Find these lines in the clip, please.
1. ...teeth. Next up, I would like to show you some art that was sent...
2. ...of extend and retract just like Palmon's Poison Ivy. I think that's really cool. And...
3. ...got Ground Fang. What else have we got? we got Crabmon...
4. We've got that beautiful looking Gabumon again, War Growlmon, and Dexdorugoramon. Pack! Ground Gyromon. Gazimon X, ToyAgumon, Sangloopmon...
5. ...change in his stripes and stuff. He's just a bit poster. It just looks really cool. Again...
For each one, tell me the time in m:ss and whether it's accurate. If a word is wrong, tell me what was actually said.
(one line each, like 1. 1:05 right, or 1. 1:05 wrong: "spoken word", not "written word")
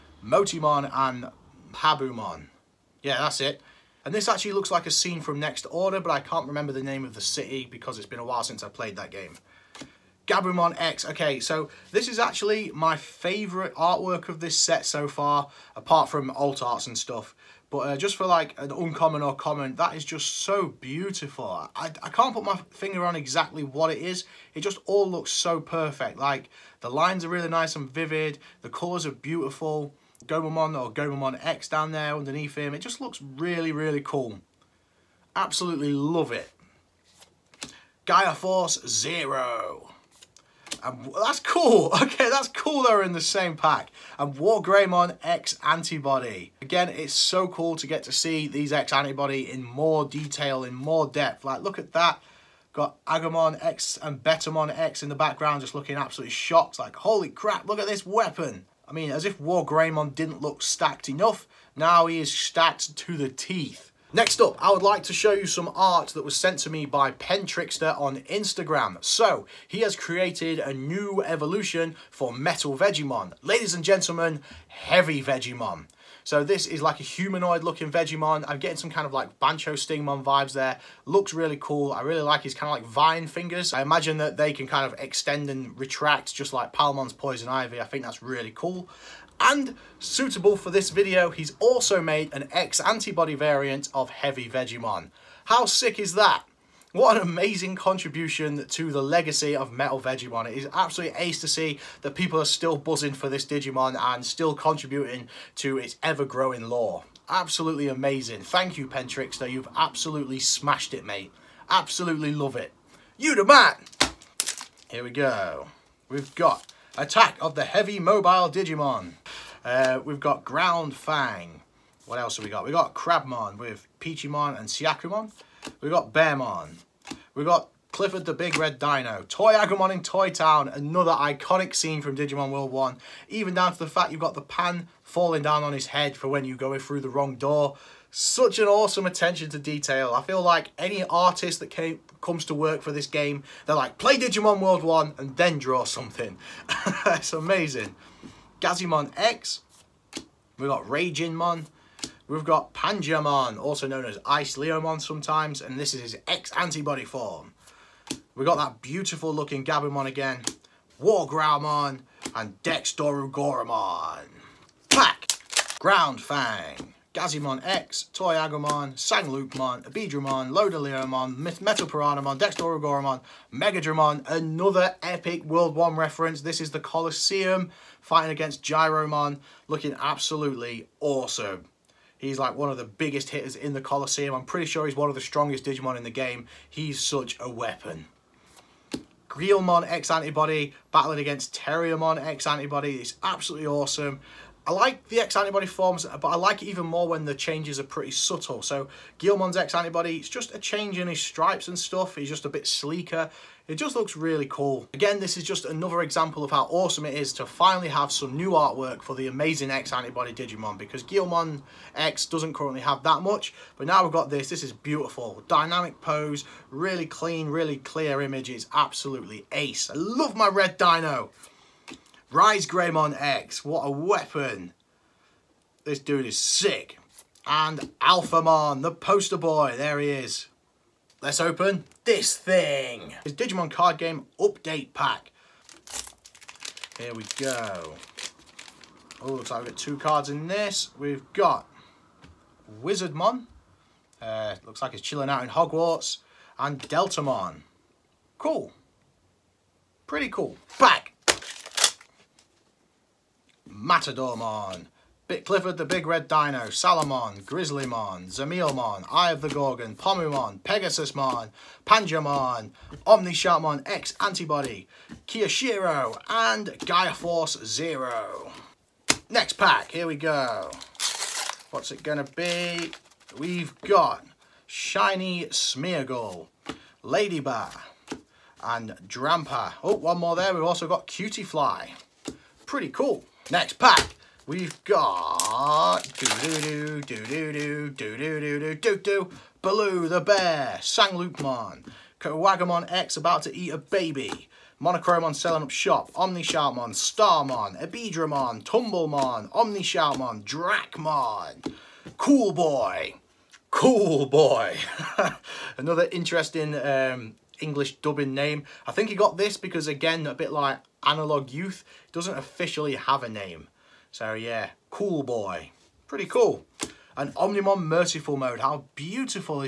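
1. 1:03 right
2. 1:24 right
3. 2:00 right
4. 2:38 wrong: "Fang", not "Gyromon"
5. 3:20 wrong: "sleeker", not "poster".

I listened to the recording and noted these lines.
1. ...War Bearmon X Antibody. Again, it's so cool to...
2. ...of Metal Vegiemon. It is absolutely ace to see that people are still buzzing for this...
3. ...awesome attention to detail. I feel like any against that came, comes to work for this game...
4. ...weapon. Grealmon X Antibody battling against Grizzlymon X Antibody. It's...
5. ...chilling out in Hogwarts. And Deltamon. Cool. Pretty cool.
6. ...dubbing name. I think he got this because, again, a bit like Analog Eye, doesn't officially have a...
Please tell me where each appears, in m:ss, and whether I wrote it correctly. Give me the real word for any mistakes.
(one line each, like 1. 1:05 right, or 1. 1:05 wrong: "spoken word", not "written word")
1. 0:44 wrong: "Greymon", not "Bearmon"
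2. 1:39 right
3. 2:18 wrong: "artist", not "against"
4. 3:07 wrong: "Terriermon", not "Grizzlymon"
5. 4:05 right
6. 5:07 wrong: "Youth", not "Eye".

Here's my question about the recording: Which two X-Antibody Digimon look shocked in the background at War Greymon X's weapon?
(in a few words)
Agumon X and Betamon X.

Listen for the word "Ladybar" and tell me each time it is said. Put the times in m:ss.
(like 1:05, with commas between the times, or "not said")
4:37.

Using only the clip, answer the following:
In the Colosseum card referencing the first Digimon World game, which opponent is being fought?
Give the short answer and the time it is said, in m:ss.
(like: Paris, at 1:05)
Gyromon, at 2:58.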